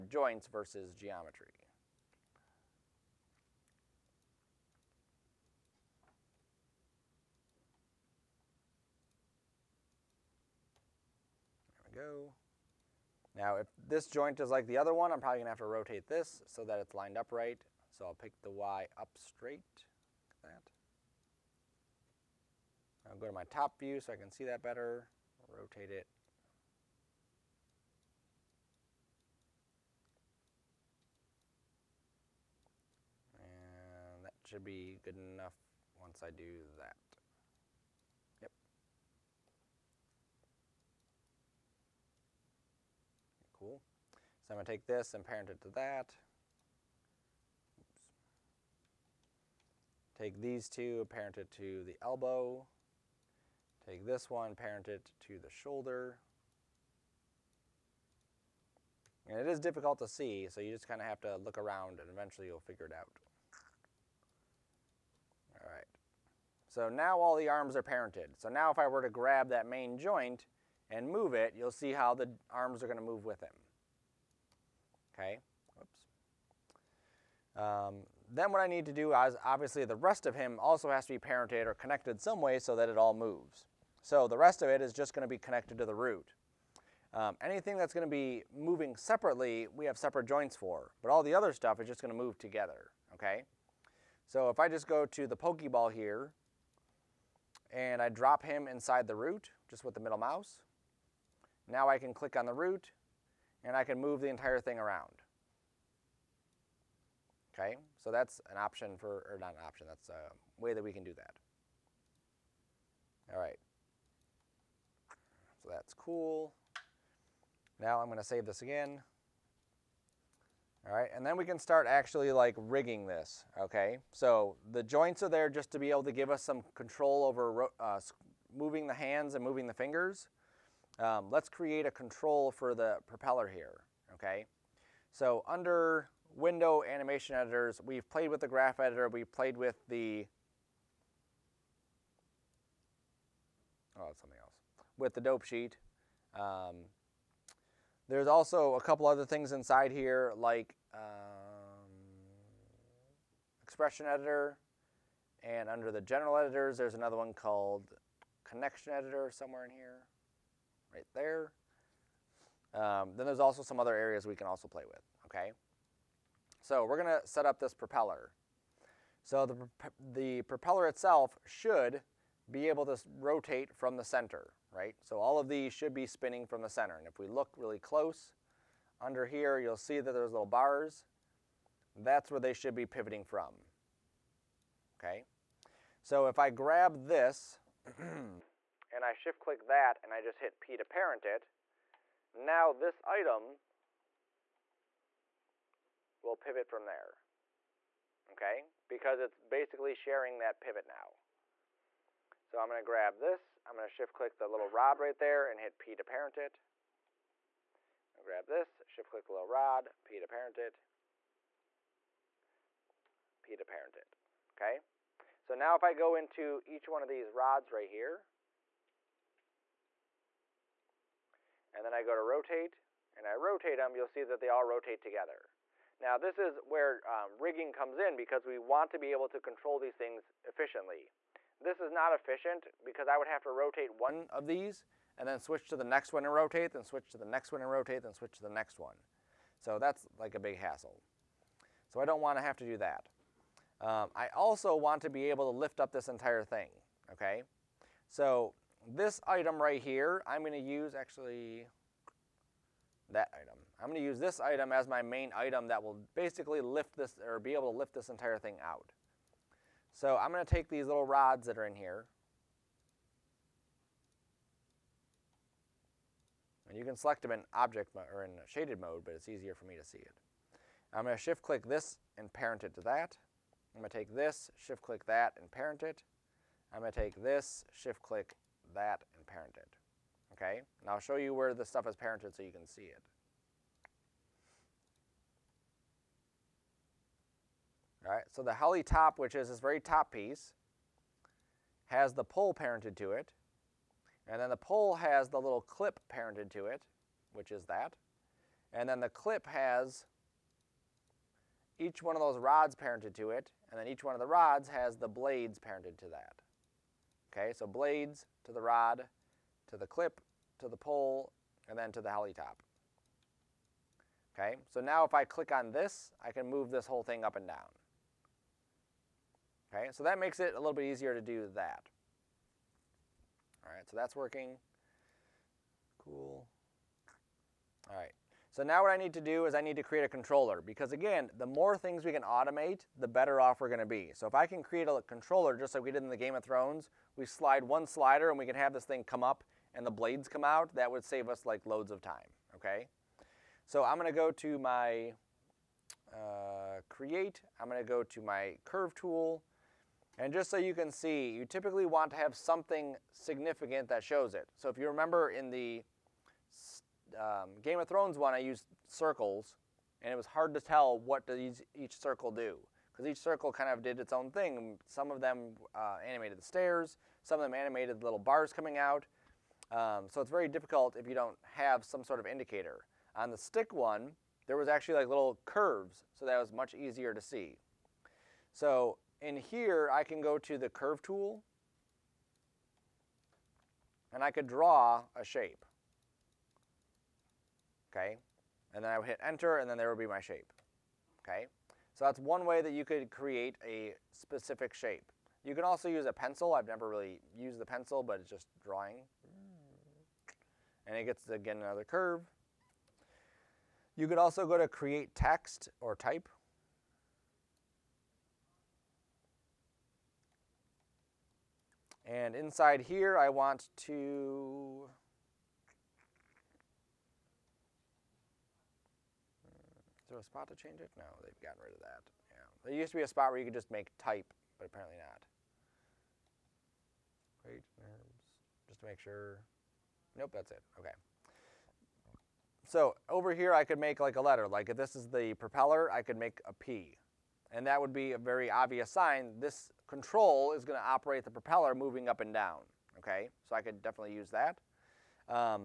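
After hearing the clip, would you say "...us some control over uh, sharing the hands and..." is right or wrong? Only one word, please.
wrong.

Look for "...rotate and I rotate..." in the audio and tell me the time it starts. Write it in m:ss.
3:42.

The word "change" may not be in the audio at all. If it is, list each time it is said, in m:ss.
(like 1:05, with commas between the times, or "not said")
7:00.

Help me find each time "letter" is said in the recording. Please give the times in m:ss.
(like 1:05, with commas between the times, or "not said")
7:14.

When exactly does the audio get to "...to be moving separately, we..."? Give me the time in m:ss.
1:28.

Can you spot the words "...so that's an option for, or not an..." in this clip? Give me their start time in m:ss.
1:48.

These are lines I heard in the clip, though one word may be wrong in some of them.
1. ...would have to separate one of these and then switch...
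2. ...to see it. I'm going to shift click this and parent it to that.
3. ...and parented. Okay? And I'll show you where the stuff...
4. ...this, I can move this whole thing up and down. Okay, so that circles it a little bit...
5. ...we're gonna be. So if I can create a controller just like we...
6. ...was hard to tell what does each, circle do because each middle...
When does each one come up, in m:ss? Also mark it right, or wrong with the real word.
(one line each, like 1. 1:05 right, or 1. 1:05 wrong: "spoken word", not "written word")
1. 3:53 wrong: "rotate", not "separate"
2. 4:29 right
3. 4:39 right
4. 5:15 wrong: "makes", not "circles"
5. 5:33 right
6. 6:00 wrong: "circle", not "middle".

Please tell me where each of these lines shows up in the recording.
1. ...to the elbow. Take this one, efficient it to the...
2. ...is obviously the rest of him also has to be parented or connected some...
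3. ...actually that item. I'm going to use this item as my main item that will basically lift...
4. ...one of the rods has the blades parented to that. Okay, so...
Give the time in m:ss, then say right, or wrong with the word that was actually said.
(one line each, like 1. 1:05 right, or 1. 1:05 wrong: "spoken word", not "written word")
1. 0:51 wrong: "parent", not "efficient"
2. 1:19 right
3. 4:10 right
4. 5:04 right.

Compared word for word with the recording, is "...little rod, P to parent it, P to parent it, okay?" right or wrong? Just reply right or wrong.
right.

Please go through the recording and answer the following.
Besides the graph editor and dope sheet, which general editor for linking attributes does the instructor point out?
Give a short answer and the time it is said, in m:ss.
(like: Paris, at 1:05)
Connection editor, at 2:38.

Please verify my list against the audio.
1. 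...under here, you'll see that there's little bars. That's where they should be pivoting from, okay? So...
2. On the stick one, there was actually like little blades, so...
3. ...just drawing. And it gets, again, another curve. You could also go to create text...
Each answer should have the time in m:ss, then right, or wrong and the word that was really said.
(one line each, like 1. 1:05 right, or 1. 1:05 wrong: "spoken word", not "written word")
1. 2:59 right
2. 6:13 wrong: "curves", not "blades"
3. 6:38 right.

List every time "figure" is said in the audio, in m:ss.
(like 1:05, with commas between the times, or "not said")
1:02.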